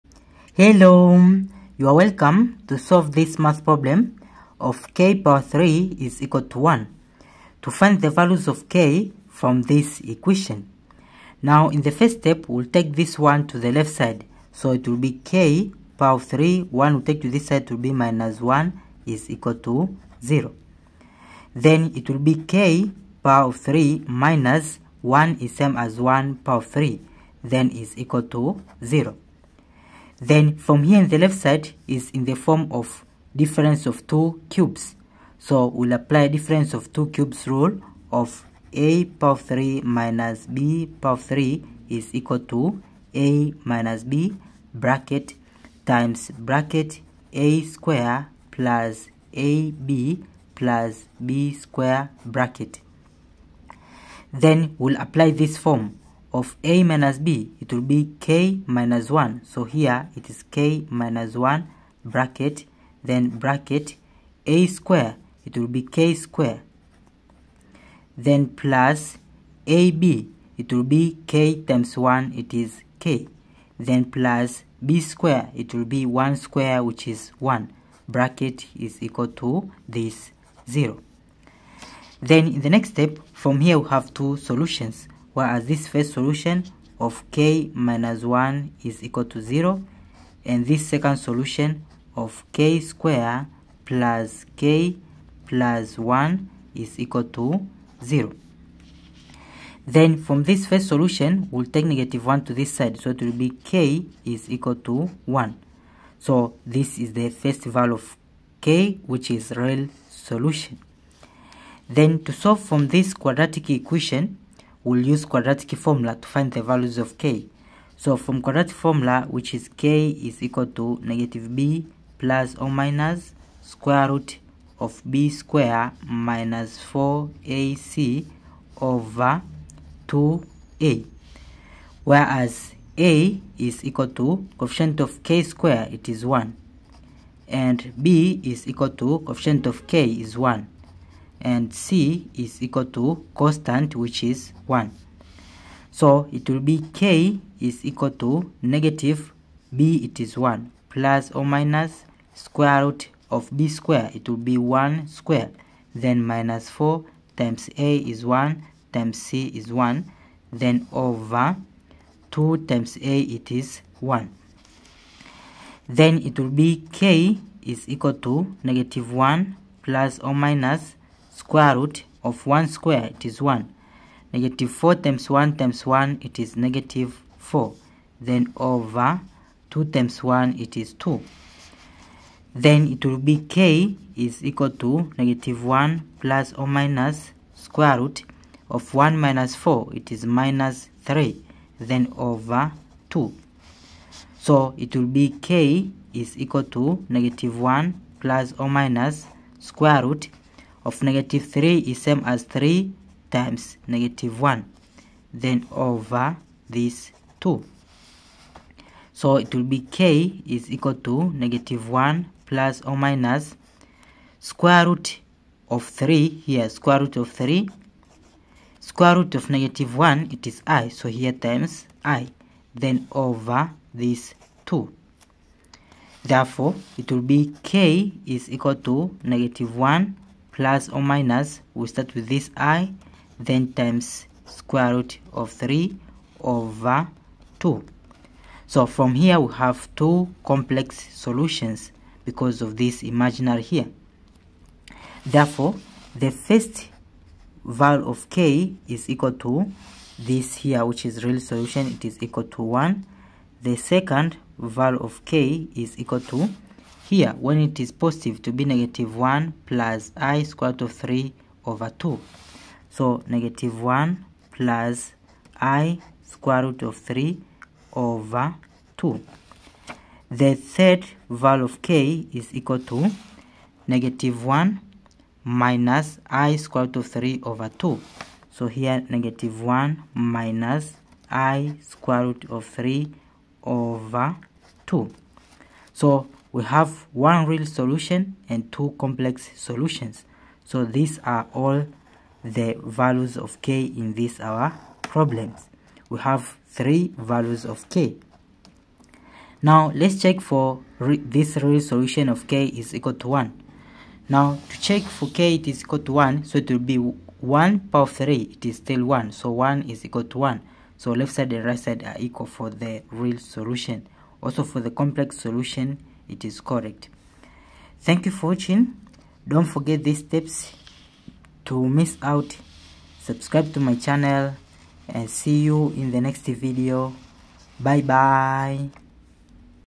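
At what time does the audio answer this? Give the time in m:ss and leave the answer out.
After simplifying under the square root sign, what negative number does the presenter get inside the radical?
3:10.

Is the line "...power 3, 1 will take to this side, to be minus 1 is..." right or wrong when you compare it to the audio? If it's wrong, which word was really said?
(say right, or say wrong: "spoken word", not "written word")
right.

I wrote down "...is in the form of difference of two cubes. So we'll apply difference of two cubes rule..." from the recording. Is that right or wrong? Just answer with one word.
right.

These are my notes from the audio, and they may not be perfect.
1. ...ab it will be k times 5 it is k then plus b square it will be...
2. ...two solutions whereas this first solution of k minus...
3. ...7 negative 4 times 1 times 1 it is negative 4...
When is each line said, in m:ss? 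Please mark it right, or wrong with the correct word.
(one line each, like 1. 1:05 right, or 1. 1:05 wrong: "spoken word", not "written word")
1. 1:09 wrong: "1", not "5"
2. 1:24 right
3. 2:53 wrong: "1", not "7".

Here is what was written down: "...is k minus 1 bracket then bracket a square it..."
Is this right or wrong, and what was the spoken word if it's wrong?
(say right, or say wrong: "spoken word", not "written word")
right.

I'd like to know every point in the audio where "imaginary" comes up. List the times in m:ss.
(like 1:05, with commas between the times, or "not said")
4:03.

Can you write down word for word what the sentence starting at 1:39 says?
Then from this first solution, we'll take negative 1 to this side.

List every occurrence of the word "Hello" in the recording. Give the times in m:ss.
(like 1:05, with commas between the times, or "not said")
0:00.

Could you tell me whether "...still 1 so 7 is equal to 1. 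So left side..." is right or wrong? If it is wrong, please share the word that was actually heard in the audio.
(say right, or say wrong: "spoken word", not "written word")
wrong: "1", not "7".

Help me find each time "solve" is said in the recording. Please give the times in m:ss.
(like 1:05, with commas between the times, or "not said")
0:02, 1:52.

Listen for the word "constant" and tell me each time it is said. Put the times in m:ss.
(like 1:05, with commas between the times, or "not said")
2:23.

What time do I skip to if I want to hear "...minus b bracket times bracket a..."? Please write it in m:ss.
0:43.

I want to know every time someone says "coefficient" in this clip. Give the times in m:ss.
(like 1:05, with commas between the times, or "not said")
2:14, 2:19.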